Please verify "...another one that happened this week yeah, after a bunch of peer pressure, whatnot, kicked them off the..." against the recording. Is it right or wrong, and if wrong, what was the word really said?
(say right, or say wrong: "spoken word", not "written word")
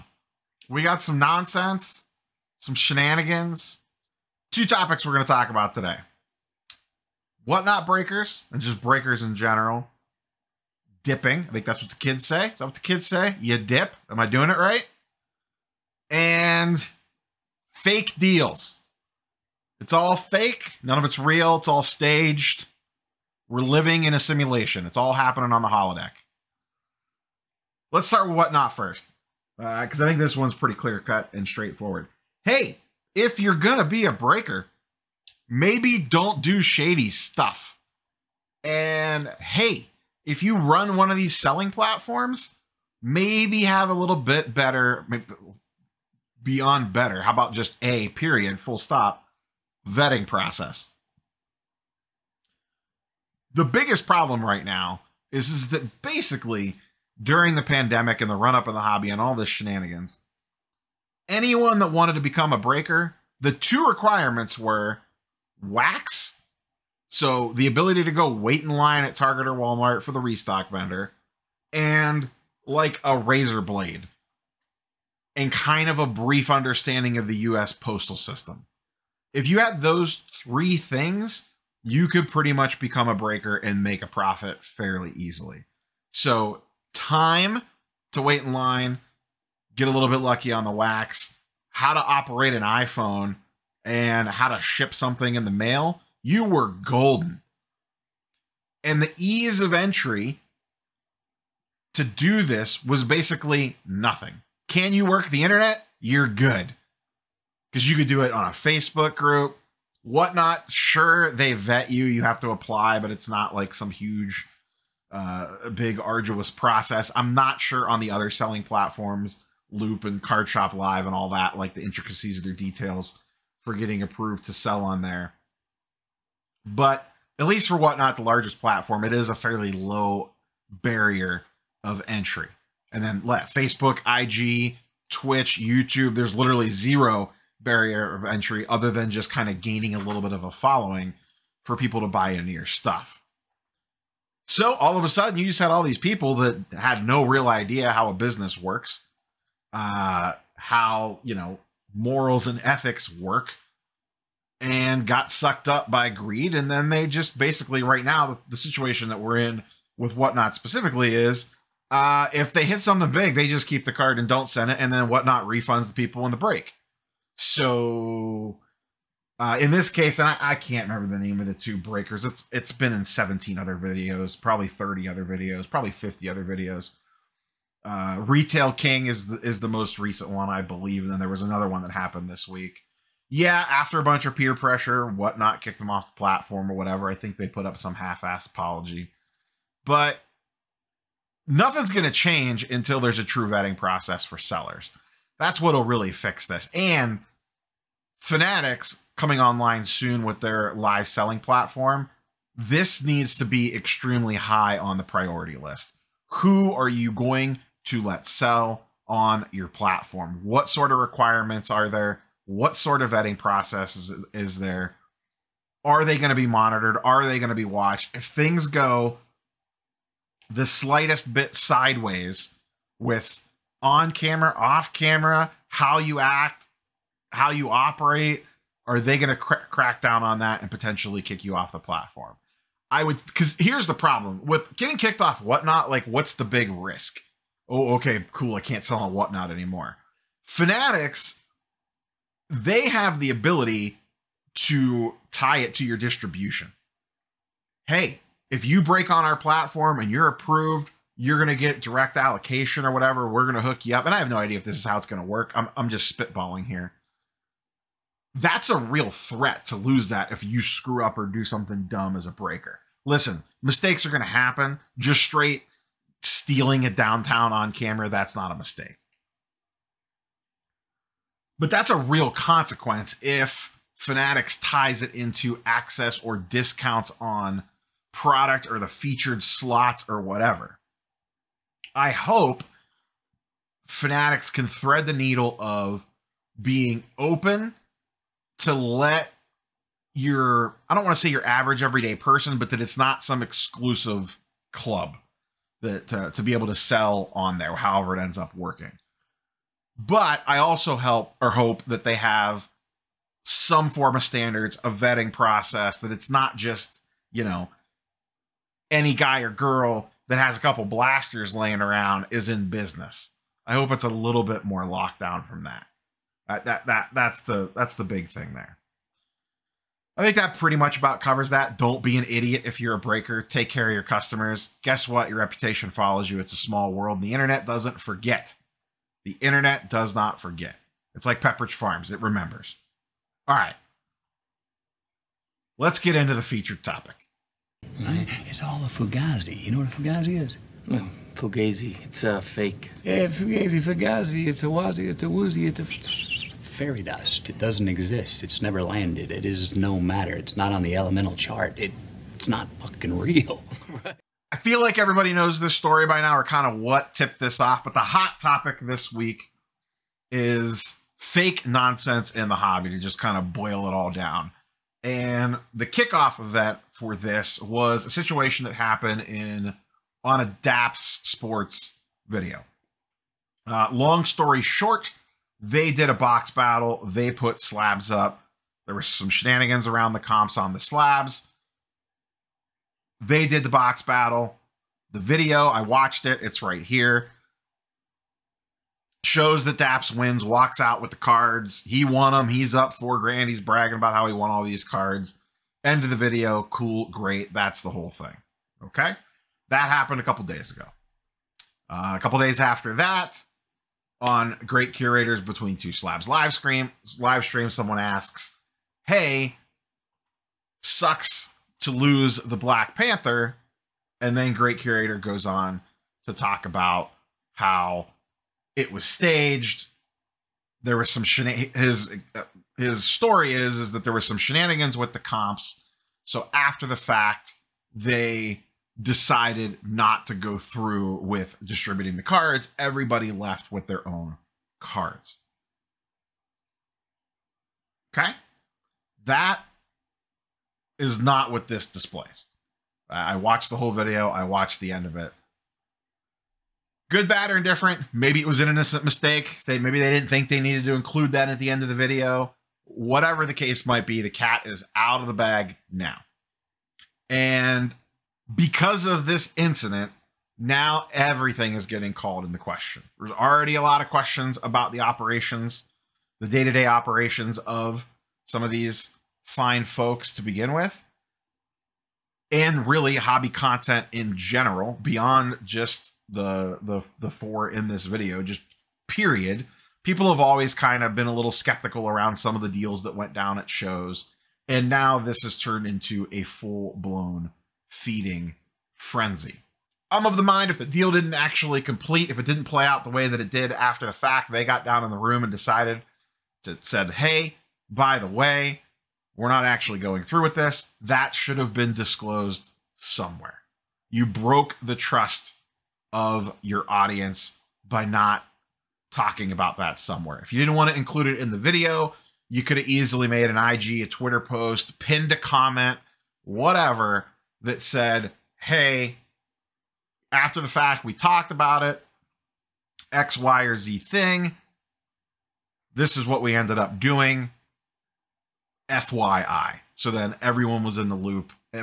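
right.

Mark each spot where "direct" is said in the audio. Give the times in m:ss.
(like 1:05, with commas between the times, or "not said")
4:11.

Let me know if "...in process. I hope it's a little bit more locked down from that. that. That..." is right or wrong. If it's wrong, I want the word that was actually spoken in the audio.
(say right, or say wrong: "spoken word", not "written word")
wrong: "business", not "process".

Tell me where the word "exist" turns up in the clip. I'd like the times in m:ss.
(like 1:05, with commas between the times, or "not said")
5:47.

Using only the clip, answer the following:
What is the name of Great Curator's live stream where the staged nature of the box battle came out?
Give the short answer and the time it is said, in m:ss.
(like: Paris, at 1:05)
Between Two Slabs, at 6:45.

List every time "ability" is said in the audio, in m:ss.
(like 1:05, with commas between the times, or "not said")
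1:07, 4:03.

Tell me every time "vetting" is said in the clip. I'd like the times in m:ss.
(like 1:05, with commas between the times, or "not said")
0:49, 3:13, 3:33, 5:04.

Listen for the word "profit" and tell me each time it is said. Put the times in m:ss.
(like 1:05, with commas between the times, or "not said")
1:24.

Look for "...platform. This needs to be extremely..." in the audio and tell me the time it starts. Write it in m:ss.
3:21.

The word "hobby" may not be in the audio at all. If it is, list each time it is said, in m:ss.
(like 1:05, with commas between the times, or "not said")
0:58, 6:02, 7:53.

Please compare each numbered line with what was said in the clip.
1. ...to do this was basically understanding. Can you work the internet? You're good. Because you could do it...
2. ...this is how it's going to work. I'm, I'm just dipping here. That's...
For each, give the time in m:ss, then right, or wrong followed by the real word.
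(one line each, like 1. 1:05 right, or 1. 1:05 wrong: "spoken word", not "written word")
1. 1:41 wrong: "nothing", not "understanding"
2. 4:14 wrong: "spitballing", not "dipping".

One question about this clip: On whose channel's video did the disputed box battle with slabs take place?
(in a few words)
Daps Sports.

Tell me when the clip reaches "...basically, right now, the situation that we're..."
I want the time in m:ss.
2:37.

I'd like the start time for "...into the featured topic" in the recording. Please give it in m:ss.
5:36.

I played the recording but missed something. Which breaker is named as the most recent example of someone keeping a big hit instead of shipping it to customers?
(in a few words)
Retail King.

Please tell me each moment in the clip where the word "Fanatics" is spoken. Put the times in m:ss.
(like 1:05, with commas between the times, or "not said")
3:18, 4:00, 4:33, 4:43.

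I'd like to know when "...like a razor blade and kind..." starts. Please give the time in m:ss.
1:12.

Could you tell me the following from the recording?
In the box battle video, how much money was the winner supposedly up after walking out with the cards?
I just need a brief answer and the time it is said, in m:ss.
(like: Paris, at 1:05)
4 grand, at 6:32.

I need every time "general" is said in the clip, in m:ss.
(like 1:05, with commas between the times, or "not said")
0:09, 7:54.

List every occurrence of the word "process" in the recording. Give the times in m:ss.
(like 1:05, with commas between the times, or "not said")
0:50, 1:56, 3:13, 3:33, 5:05.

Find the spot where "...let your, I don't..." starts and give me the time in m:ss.
4:48.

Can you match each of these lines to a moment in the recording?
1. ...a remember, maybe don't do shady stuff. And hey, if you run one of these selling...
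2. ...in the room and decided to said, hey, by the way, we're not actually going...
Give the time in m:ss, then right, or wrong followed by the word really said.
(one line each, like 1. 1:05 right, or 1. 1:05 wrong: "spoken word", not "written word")
1. 0:34 wrong: "breaker", not "remember"
2. 8:15 right.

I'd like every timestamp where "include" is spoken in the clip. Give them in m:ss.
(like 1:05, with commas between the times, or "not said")
7:30, 8:30.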